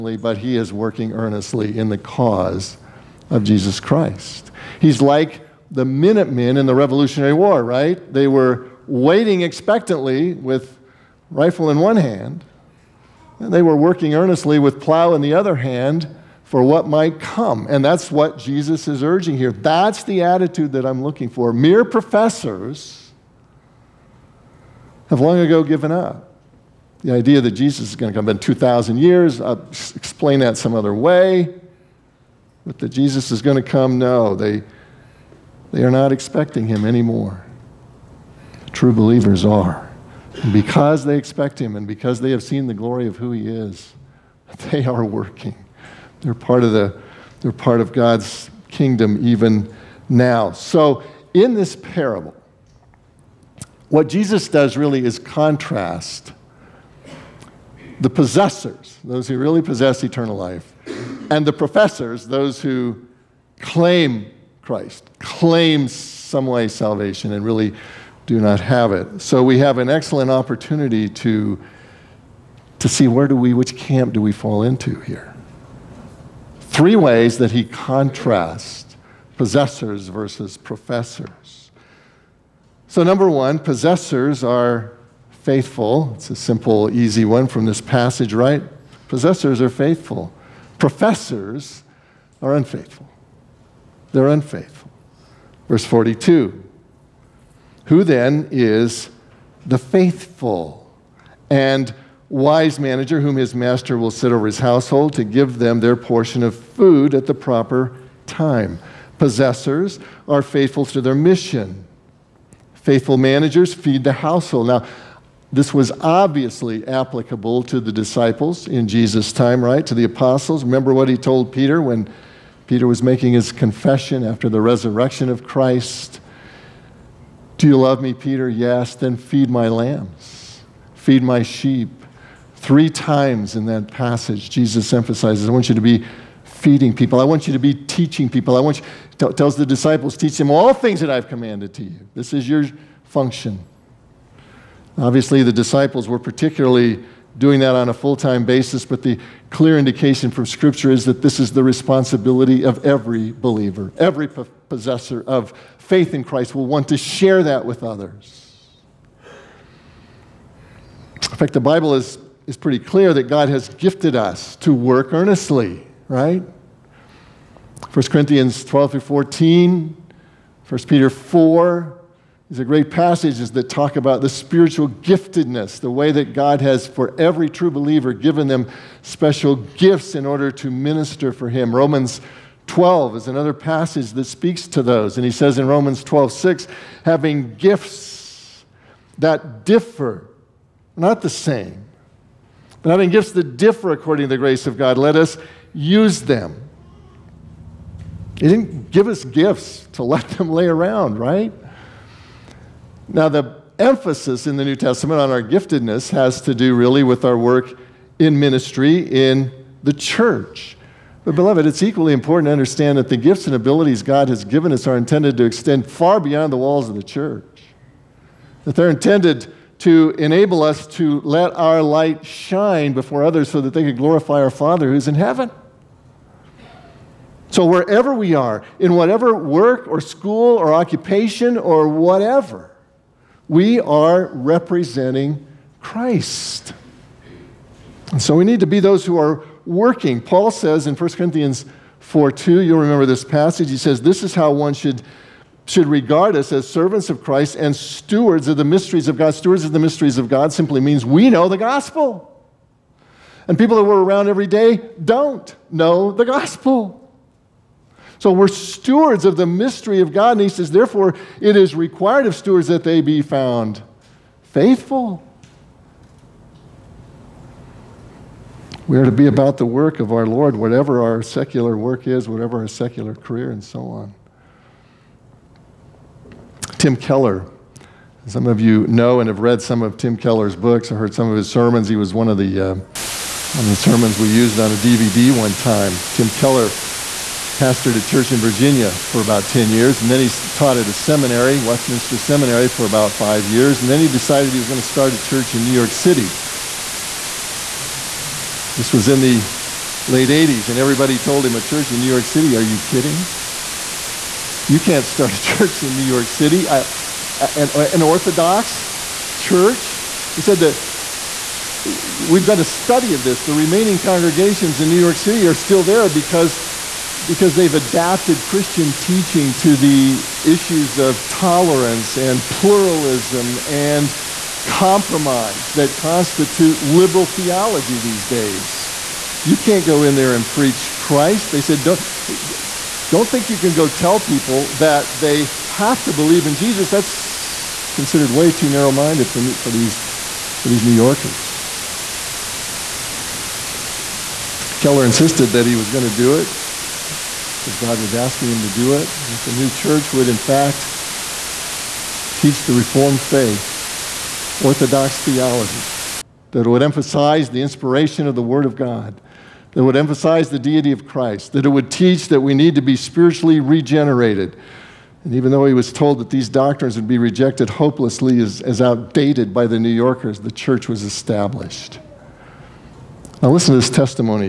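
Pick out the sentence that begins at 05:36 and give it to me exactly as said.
That's considered way too narrow minded for, for, these, for these New Yorkers.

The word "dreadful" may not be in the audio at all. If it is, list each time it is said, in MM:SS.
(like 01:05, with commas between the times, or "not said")
not said.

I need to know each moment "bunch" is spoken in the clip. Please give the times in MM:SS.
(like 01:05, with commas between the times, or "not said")
not said.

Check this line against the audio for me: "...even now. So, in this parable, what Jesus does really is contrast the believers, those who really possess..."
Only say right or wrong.
wrong.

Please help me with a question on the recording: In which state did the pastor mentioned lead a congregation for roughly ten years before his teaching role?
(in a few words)
Virginia.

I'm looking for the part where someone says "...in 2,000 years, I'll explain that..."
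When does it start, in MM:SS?
00:28.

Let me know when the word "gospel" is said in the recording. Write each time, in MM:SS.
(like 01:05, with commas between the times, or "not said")
04:11, 04:16.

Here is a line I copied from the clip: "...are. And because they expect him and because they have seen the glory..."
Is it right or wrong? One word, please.
right.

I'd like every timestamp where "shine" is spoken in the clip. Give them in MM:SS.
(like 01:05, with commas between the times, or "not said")
03:42.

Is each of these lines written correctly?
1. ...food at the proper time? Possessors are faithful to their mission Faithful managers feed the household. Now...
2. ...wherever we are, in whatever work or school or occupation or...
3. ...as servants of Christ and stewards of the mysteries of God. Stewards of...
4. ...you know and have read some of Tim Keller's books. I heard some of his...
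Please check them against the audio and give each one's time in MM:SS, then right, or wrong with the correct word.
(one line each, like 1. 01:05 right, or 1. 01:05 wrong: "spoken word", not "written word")
1. 01:46 right
2. 03:47 right
3. 04:06 right
4. 04:38 right.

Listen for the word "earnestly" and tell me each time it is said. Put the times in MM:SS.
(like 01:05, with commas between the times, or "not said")
00:01, 00:14, 02:45.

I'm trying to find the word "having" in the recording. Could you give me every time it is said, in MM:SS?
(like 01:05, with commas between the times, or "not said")
03:07, 03:12.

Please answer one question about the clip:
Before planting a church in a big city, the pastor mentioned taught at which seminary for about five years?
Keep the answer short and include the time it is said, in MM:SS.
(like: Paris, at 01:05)
Westminster Seminary, at 04:51.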